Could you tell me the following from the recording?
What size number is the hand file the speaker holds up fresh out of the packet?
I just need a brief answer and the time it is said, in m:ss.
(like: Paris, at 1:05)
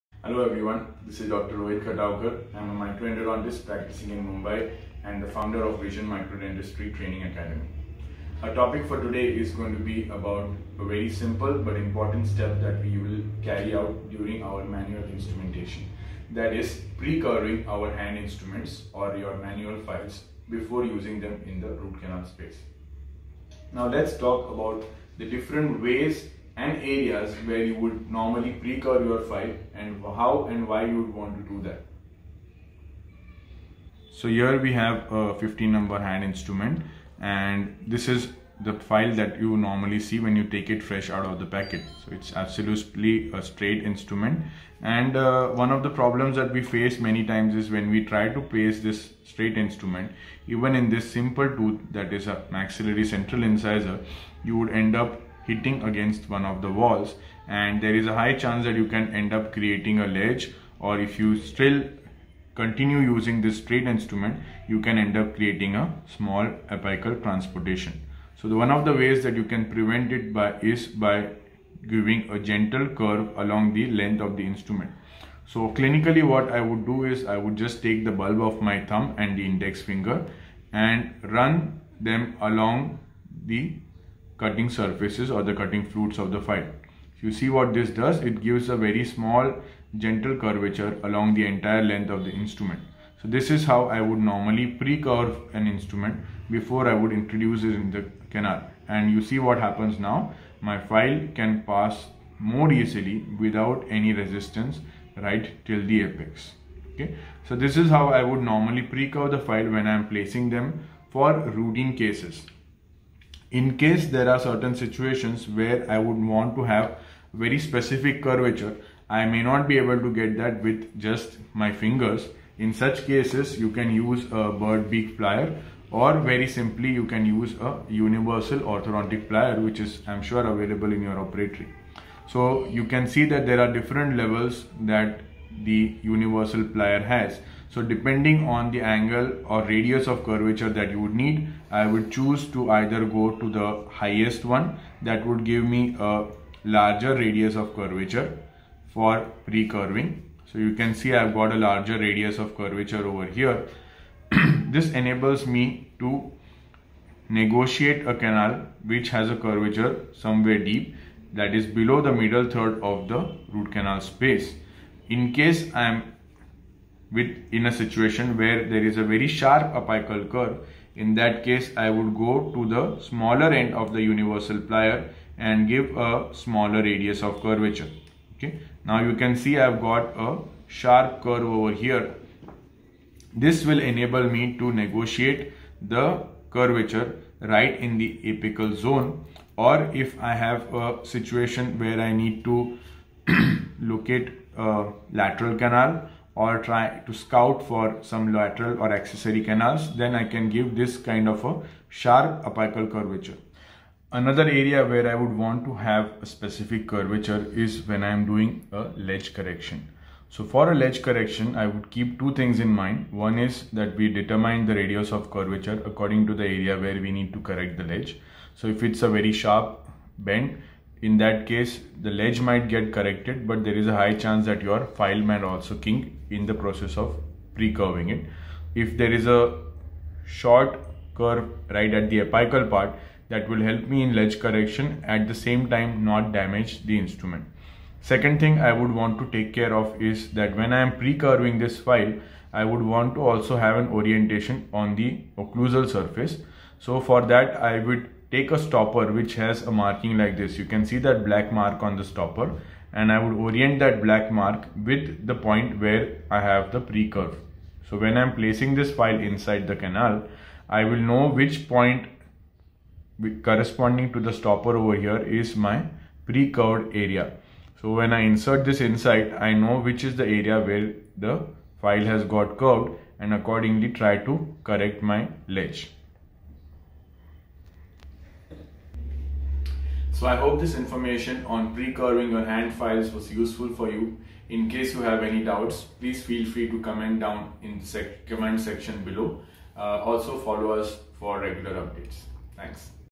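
15, at 0:35.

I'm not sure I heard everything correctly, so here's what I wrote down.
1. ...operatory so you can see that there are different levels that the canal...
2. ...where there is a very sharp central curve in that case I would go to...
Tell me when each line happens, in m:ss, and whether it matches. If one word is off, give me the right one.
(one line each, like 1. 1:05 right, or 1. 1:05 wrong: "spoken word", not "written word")
1. 2:11 wrong: "universal", not "canal"
2. 2:48 wrong: "apical", not "central".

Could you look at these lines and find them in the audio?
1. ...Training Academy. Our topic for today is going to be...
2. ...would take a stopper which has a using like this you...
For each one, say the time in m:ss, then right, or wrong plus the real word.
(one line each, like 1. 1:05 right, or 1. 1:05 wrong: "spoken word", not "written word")
1. 0:06 right
2. 4:07 wrong: "marking", not "using".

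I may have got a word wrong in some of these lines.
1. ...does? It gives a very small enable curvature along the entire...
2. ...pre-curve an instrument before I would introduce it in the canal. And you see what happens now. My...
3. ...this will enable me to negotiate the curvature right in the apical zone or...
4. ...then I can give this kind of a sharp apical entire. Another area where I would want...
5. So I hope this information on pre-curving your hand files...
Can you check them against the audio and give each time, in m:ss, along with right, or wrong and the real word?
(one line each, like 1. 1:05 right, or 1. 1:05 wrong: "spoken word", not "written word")
1. 1:27 wrong: "gentle", not "enable"
2. 1:34 right
3. 3:03 right
4. 3:19 wrong: "curvature", not "entire"
5. 4:40 right.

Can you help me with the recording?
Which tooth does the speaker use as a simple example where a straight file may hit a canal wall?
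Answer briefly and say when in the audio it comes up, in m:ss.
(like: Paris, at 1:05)
Maxillary central incisor, at 0:52.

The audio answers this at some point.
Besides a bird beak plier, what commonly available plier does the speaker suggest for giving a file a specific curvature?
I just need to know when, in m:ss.
2:07.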